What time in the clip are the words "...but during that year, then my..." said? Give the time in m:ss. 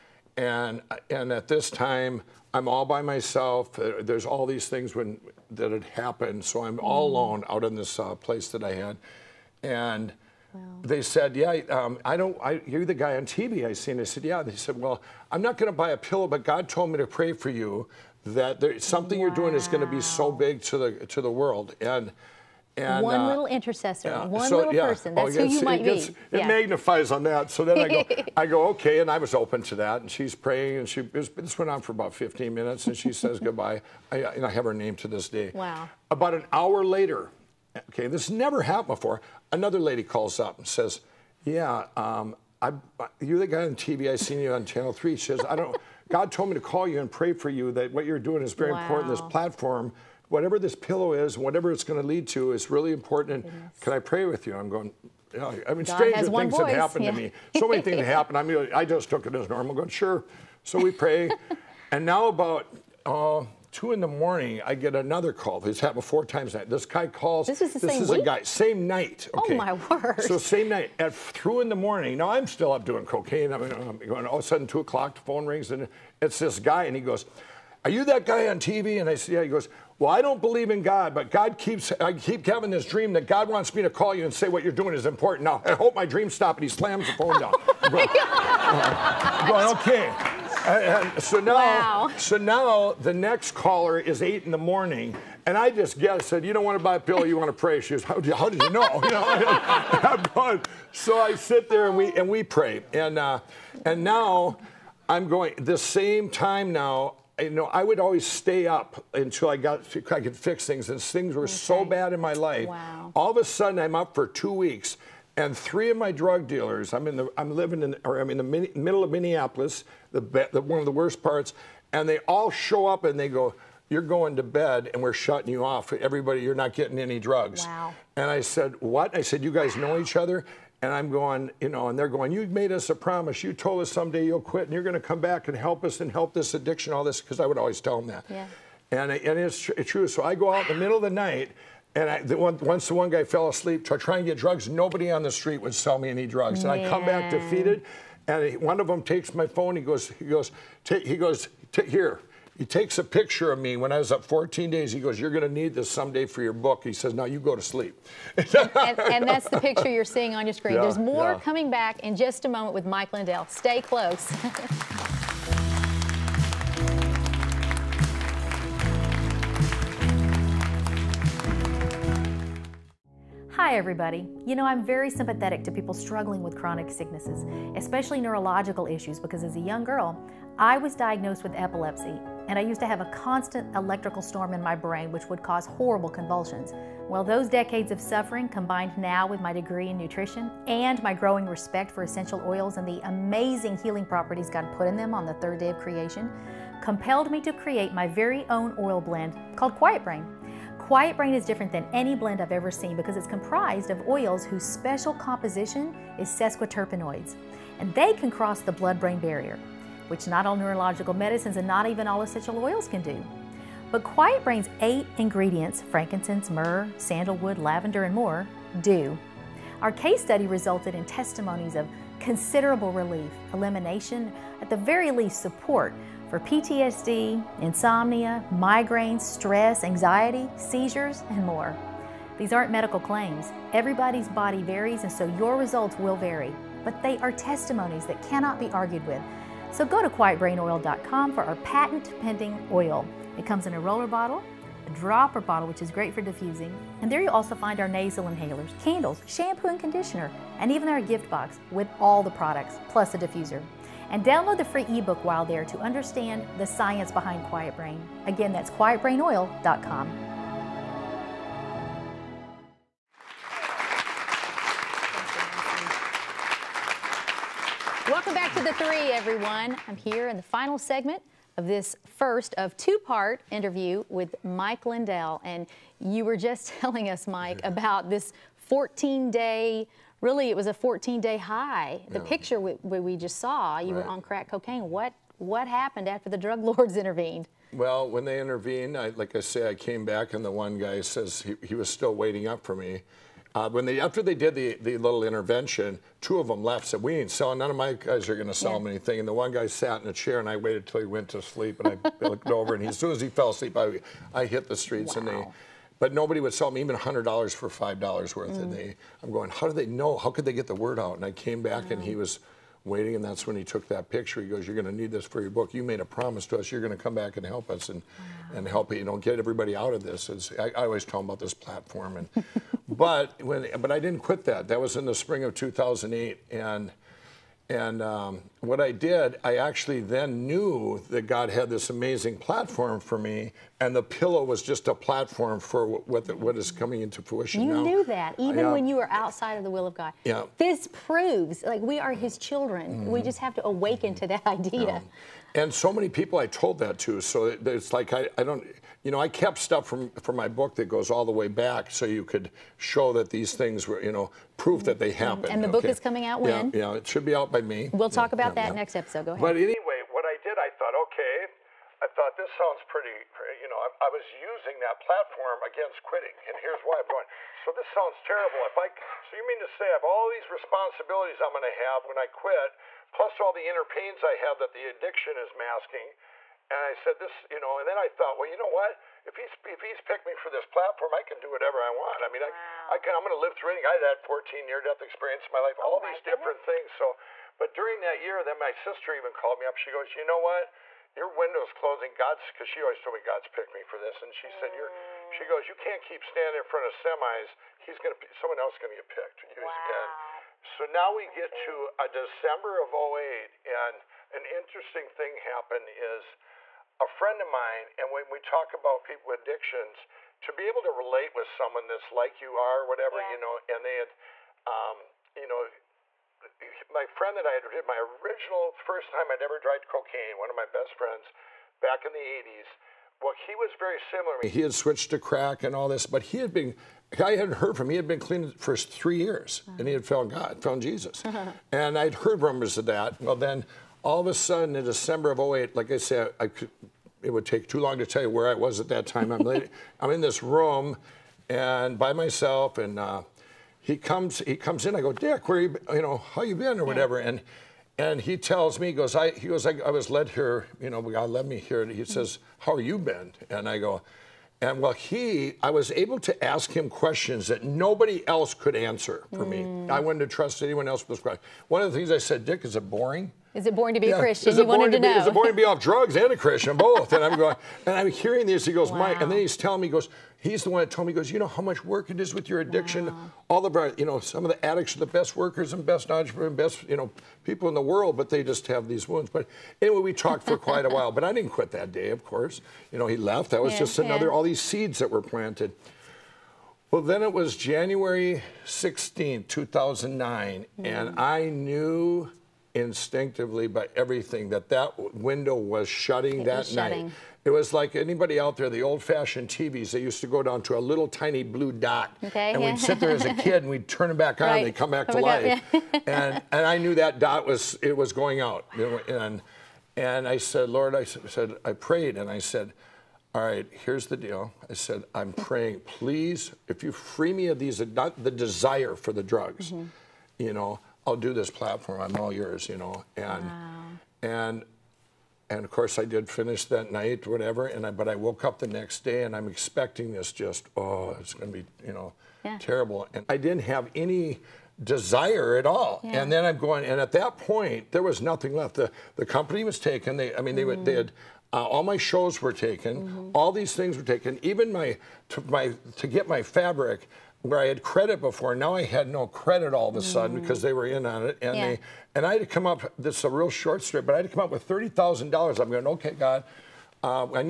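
6:27.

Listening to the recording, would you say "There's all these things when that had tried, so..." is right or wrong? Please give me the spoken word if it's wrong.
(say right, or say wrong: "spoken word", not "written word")
wrong: "happened", not "tried".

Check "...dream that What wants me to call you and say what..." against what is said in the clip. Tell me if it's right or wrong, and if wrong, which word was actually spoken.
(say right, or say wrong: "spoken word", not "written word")
wrong: "God", not "What".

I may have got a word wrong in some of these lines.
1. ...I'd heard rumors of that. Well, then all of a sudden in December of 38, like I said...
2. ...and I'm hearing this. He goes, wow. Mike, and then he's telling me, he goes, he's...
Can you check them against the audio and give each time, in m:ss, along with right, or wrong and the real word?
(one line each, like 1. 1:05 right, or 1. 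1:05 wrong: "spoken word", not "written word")
1. 7:11 wrong: "08", not "38"
2. 7:47 right.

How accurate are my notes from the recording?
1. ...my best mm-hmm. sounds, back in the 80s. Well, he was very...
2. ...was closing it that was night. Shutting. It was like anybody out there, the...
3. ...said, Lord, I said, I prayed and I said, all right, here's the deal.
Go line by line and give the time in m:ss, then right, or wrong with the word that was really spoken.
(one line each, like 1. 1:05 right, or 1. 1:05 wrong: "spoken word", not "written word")
1. 7:00 wrong: "friends", not "sounds"
2. 8:15 wrong: "shutting", not "closing"
3. 8:30 right.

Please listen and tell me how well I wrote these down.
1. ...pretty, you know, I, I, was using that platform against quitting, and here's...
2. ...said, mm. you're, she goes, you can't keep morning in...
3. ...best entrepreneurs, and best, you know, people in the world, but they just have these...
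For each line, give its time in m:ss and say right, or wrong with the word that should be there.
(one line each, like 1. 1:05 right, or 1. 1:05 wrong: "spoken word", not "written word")
1. 6:02 right
2. 6:34 wrong: "standing", not "morning"
3. 7:55 right.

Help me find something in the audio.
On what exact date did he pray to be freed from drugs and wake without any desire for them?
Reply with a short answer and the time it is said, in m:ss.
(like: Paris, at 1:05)
January 16, 2009, at 8:07.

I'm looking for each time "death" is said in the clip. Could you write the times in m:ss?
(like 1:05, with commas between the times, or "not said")
6:24.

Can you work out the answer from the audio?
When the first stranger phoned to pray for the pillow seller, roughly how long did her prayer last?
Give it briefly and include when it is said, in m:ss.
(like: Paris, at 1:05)
15 minutes, at 0:32.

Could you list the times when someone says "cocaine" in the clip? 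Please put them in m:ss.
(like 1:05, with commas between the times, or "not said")
1:13, 4:44, 6:59.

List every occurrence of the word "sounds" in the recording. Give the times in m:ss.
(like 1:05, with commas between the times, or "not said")
6:02, 6:07.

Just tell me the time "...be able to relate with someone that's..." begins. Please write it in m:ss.
6:50.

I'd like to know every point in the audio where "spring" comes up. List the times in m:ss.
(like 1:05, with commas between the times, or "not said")
5:25.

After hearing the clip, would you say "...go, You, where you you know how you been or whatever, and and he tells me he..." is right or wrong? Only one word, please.
wrong.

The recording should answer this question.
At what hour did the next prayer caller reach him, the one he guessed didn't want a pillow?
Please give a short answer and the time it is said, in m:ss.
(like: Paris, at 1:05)
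8 in the morning, at 1:34.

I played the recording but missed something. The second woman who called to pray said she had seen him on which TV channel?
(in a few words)
Channel Three.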